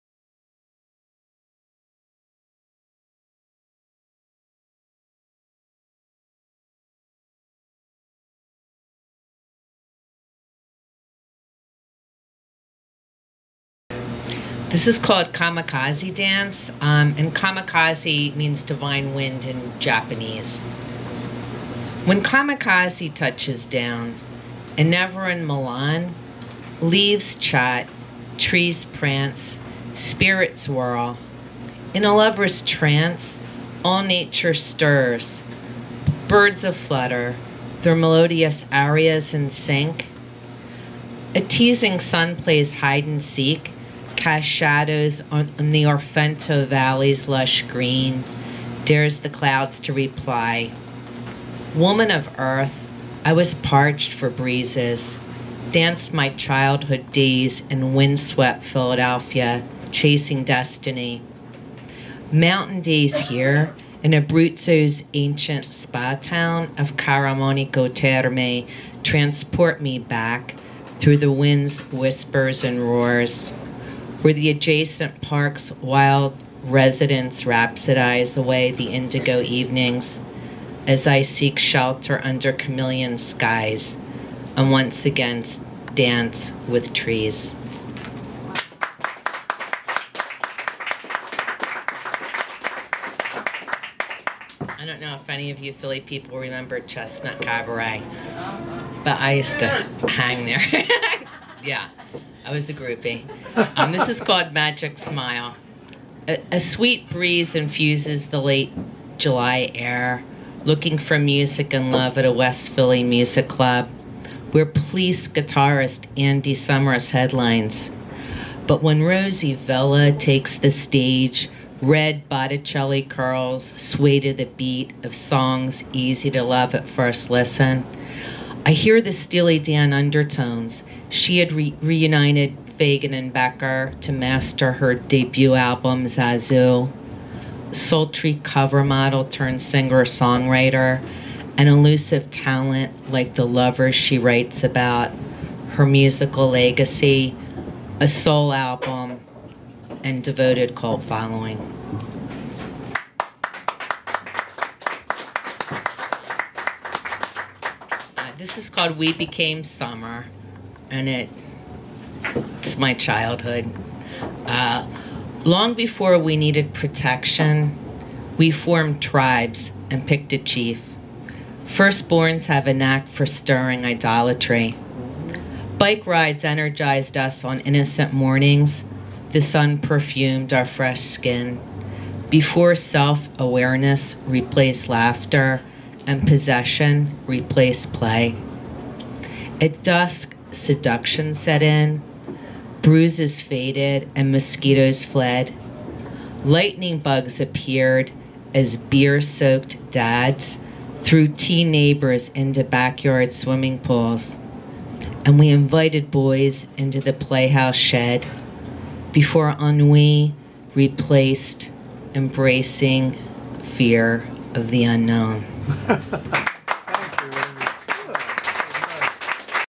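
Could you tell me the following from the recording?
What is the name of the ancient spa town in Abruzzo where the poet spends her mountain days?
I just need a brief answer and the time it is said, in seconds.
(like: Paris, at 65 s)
Caramanico Terme, at 66 s.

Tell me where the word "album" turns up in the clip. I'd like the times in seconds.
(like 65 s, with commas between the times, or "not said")
135 s, 148 s.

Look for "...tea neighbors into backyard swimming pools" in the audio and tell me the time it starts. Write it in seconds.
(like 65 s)
201 s.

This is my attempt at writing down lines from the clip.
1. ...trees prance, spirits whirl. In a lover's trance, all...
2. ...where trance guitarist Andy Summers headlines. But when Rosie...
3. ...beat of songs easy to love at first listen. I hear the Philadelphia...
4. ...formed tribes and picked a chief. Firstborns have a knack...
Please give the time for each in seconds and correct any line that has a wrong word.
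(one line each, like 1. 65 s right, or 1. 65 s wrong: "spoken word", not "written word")
1. 28 s right
2. 114 s wrong: "police", not "trance"
3. 124 s wrong: "Steely", not "Philadelphia"
4. 168 s right.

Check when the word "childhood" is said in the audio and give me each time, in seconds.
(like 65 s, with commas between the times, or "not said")
56 s, 162 s.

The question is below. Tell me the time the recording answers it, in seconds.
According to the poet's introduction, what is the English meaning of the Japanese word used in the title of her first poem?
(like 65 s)
18 s.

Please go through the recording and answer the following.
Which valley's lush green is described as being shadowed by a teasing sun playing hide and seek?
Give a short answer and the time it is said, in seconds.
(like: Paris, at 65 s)
Orfento Valley, at 45 s.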